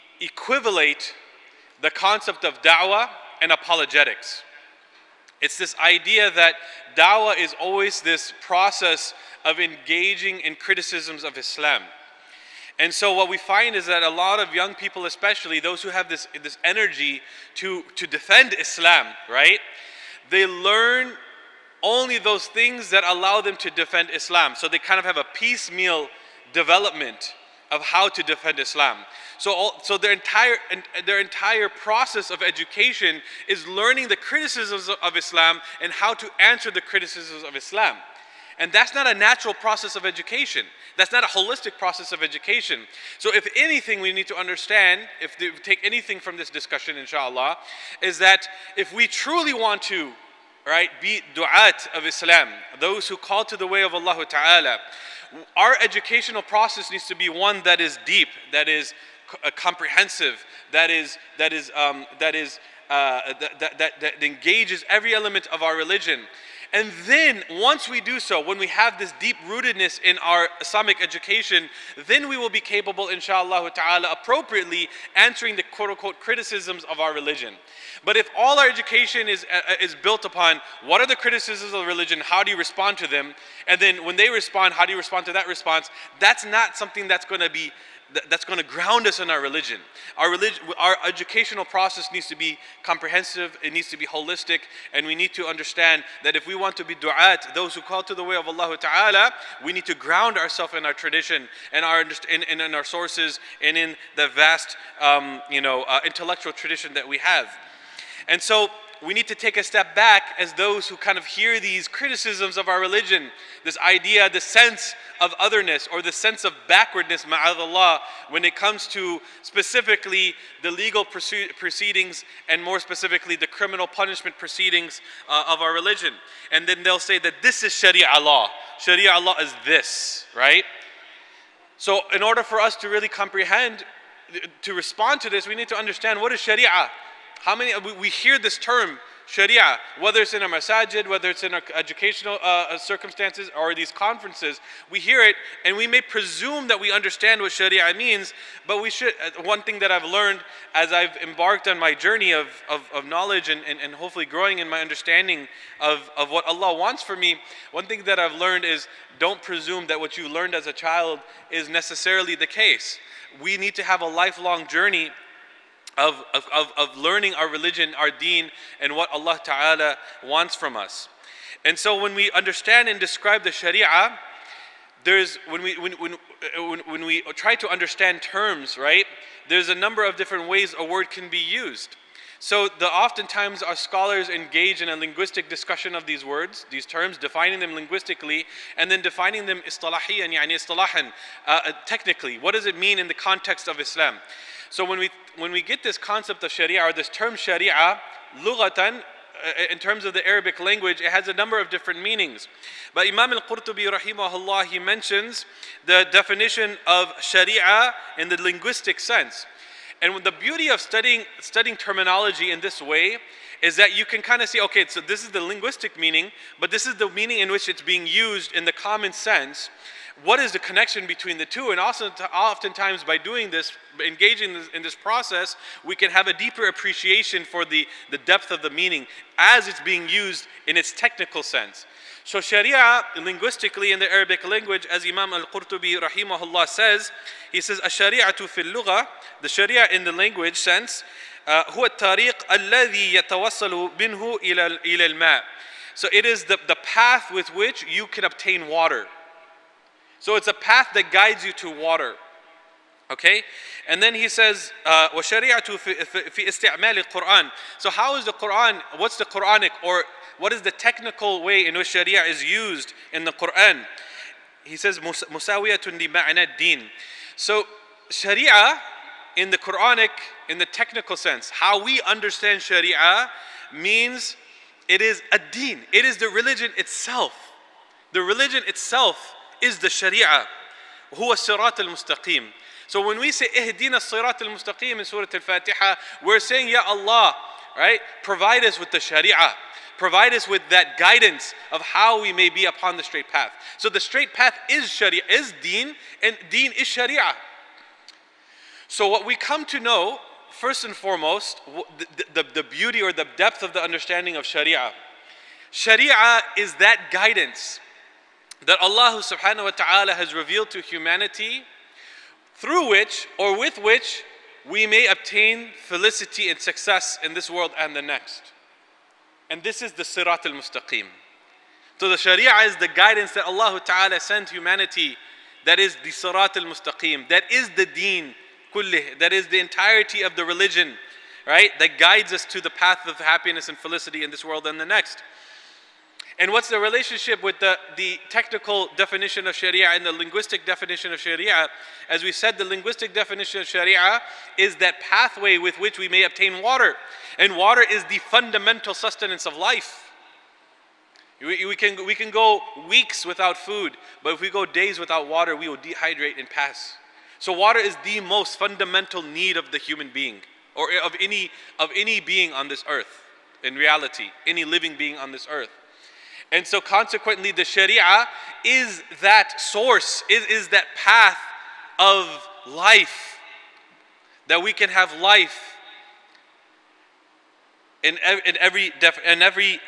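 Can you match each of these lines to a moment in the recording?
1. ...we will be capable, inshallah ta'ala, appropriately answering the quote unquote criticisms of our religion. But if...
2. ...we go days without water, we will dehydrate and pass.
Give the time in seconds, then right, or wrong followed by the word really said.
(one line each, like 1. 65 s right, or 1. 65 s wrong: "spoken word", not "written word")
1. 72 s right
2. 354 s right.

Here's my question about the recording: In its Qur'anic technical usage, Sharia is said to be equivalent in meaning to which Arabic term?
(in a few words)
Din.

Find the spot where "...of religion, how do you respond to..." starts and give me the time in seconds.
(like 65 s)
81 s.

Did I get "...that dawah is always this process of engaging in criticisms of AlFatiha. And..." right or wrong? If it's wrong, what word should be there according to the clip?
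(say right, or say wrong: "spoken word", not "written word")
wrong: "Islam", not "AlFatiha".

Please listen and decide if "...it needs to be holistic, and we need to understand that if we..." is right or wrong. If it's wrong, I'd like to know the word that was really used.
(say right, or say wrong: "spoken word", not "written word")
right.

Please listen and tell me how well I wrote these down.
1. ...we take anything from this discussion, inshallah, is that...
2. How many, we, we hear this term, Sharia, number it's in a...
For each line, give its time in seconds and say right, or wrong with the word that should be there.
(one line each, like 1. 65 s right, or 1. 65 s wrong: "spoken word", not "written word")
1. 45 s right
2. 137 s wrong: "whether", not "number".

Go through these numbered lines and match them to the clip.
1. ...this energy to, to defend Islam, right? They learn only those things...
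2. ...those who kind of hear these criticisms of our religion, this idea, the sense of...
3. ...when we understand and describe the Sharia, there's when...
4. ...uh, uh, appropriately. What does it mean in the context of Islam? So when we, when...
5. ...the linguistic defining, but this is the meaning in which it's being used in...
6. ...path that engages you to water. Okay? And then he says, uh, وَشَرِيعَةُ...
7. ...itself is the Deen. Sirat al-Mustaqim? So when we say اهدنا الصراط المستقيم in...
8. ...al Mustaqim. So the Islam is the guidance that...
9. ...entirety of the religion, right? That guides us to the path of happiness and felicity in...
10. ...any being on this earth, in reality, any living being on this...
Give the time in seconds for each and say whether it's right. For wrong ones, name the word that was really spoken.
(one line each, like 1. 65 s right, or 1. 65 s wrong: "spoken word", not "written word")
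1. 16 s right
2. 110 s right
3. 172 s right
4. 191 s wrong: "technically", not "appropriately"
5. 215 s wrong: "meaning", not "defining"
6. 250 s wrong: "guides", not "engages"
7. 278 s wrong: "Sharia", not "Deen"
8. 320 s wrong: "Sharia", not "Islam"
9. 329 s right
10. 361 s right.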